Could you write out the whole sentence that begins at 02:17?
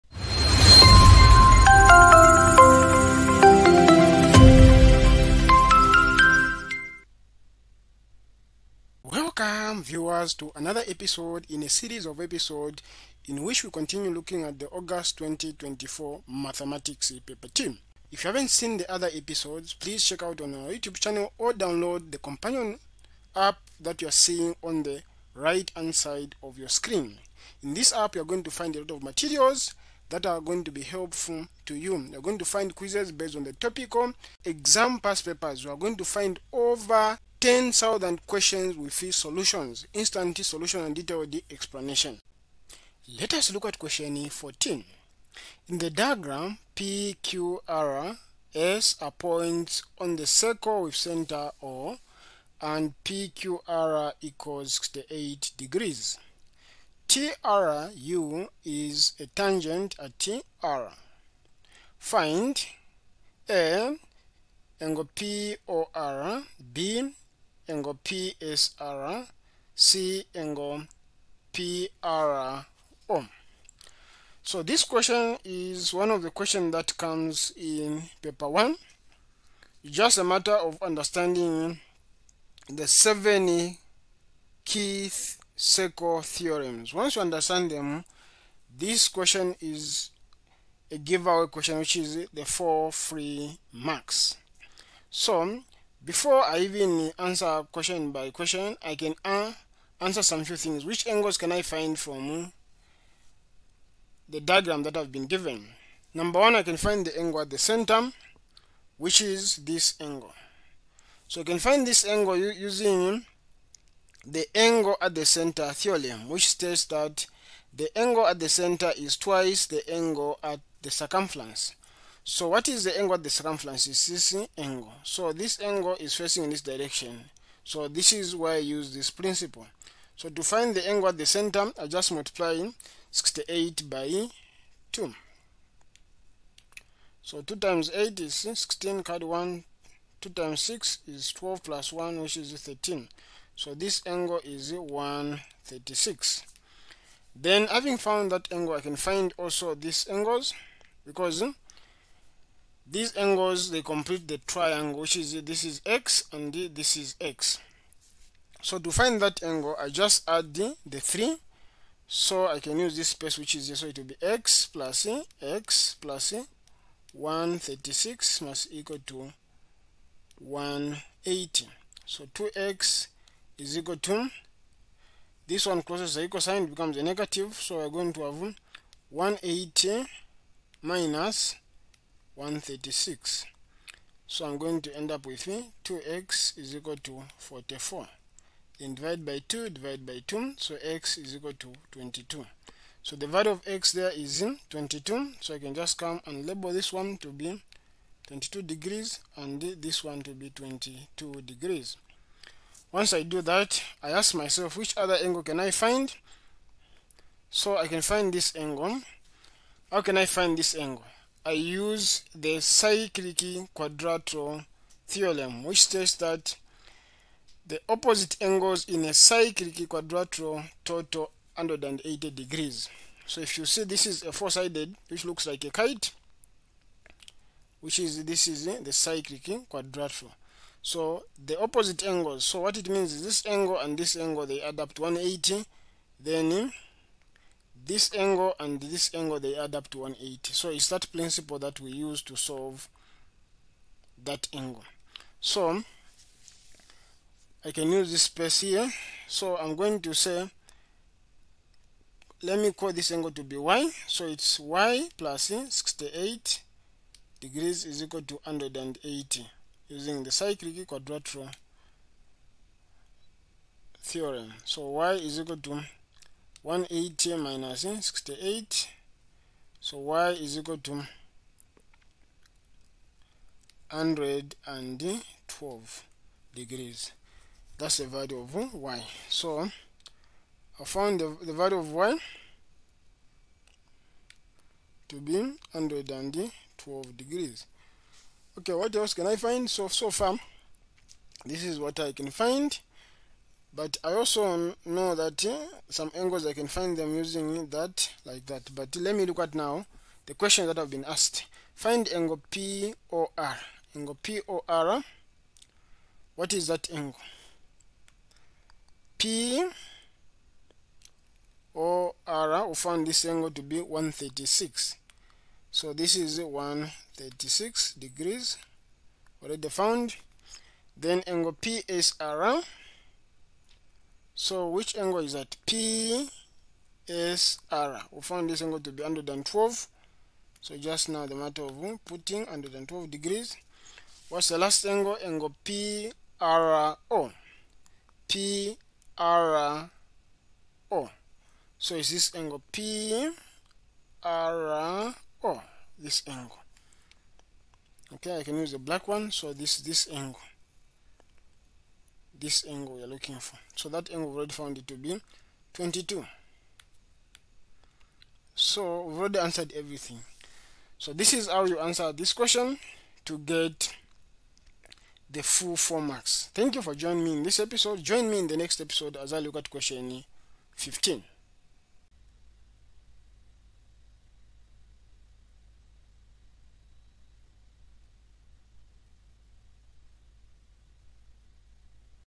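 So 2 times 8 is 16, card 1, 2 times 6 is 12 plus 1, which is 13.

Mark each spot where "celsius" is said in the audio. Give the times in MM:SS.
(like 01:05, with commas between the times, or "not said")
not said.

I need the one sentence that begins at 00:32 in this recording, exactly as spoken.
You're going to find quizzes based on the topical exam past papers.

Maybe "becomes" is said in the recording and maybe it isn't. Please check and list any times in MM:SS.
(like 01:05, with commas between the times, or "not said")
02:56.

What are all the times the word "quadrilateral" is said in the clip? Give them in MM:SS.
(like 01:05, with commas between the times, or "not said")
03:33, 03:39, 03:49, 04:20.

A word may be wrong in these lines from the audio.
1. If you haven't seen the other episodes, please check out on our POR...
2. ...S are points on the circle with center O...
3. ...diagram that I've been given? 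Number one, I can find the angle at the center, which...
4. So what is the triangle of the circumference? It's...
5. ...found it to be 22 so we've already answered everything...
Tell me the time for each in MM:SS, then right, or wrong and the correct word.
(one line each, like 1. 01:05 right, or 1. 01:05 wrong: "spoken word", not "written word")
1. 00:18 wrong: "YouTube", not "POR"
2. 00:48 right
3. 01:44 right
4. 02:02 wrong: "angle", not "triangle"
5. 05:54 right.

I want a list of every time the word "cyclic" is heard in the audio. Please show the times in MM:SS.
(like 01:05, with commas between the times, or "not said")
03:32, 03:39, 03:48, 04:20.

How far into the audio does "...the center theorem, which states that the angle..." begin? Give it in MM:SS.
01:55.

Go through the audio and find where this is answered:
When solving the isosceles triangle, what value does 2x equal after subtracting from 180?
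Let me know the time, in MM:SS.
03:07.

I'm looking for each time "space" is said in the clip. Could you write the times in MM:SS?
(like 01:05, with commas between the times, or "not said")
02:43, 04:08.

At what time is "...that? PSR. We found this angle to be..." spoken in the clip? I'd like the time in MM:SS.
05:25.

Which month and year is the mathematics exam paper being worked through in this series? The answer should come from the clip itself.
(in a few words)
August 2024.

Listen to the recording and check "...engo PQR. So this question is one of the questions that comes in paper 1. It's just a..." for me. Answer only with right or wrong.
wrong.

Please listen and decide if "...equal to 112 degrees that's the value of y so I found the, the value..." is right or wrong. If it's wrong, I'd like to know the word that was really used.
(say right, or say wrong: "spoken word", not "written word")
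right.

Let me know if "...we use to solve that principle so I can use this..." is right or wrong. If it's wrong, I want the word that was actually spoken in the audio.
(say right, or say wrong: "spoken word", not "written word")
wrong: "angle", not "principle".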